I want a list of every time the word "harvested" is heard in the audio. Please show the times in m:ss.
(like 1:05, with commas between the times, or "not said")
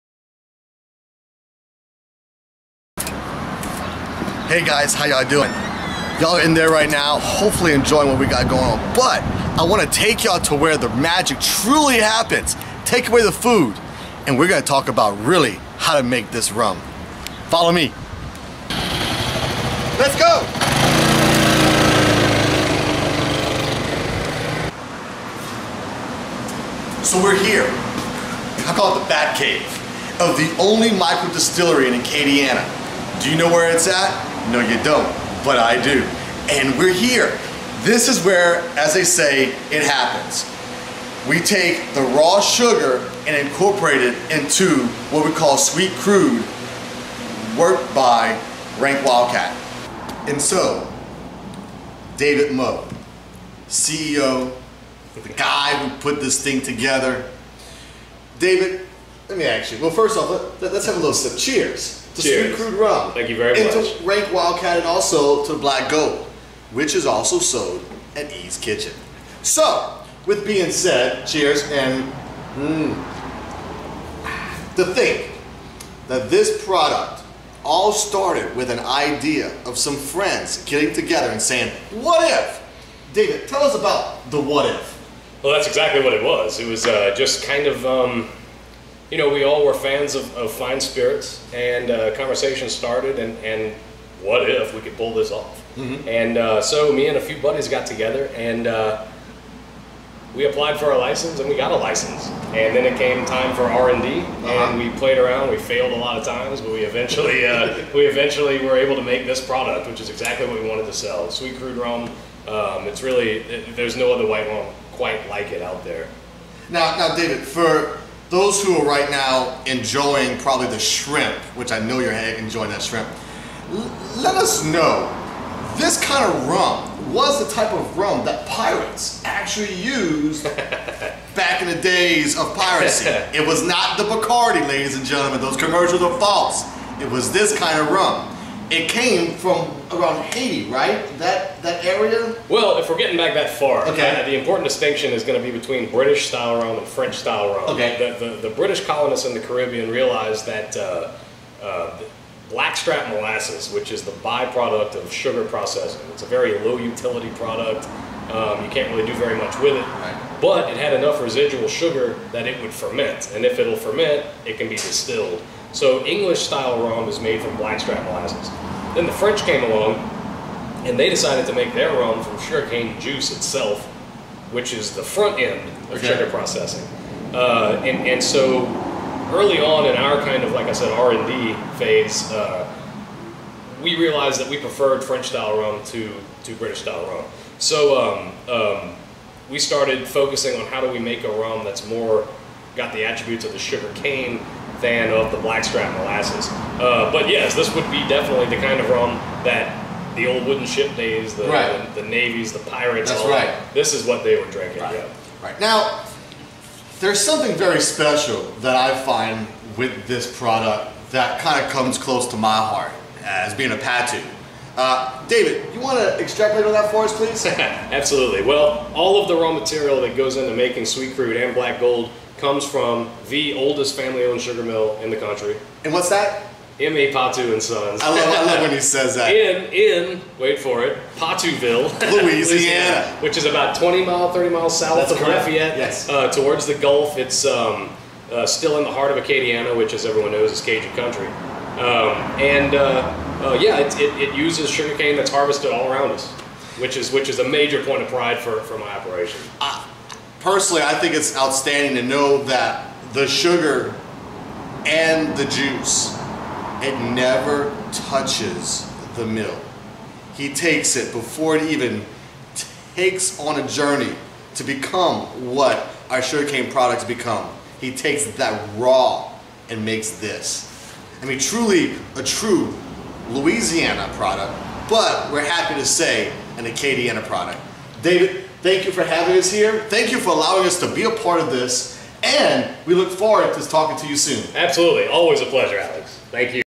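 4:05.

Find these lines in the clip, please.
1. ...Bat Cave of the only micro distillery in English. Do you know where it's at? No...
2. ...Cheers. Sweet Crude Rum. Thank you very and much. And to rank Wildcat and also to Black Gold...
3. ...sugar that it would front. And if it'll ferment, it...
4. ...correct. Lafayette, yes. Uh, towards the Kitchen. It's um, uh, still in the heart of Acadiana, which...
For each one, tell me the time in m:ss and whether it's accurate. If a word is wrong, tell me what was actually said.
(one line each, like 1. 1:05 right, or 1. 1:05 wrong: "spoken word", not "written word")
1. 0:29 wrong: "Acadiana", not "English"
2. 1:02 right
3. 2:41 wrong: "ferment", not "front"
4. 3:55 wrong: "Gulf", not "Kitchen".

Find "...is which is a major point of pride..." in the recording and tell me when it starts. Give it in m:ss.
4:06.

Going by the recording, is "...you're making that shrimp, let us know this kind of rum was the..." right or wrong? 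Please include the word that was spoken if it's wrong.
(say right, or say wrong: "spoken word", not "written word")
wrong: "enjoying", not "making".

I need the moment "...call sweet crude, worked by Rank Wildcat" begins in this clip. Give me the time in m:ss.
0:45.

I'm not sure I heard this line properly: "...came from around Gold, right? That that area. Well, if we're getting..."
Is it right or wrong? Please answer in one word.
wrong.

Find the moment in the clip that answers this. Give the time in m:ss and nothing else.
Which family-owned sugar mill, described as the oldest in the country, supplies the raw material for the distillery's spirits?
3:46.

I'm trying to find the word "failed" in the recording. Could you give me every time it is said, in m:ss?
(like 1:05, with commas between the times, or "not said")
1:45.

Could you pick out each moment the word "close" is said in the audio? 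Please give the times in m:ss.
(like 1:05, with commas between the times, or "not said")
3:31.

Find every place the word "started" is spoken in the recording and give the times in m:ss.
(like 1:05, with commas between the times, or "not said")
1:17, 1:32, 3:09.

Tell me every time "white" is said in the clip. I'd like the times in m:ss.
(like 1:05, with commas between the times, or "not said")
1:54.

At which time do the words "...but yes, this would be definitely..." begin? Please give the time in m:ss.
3:17.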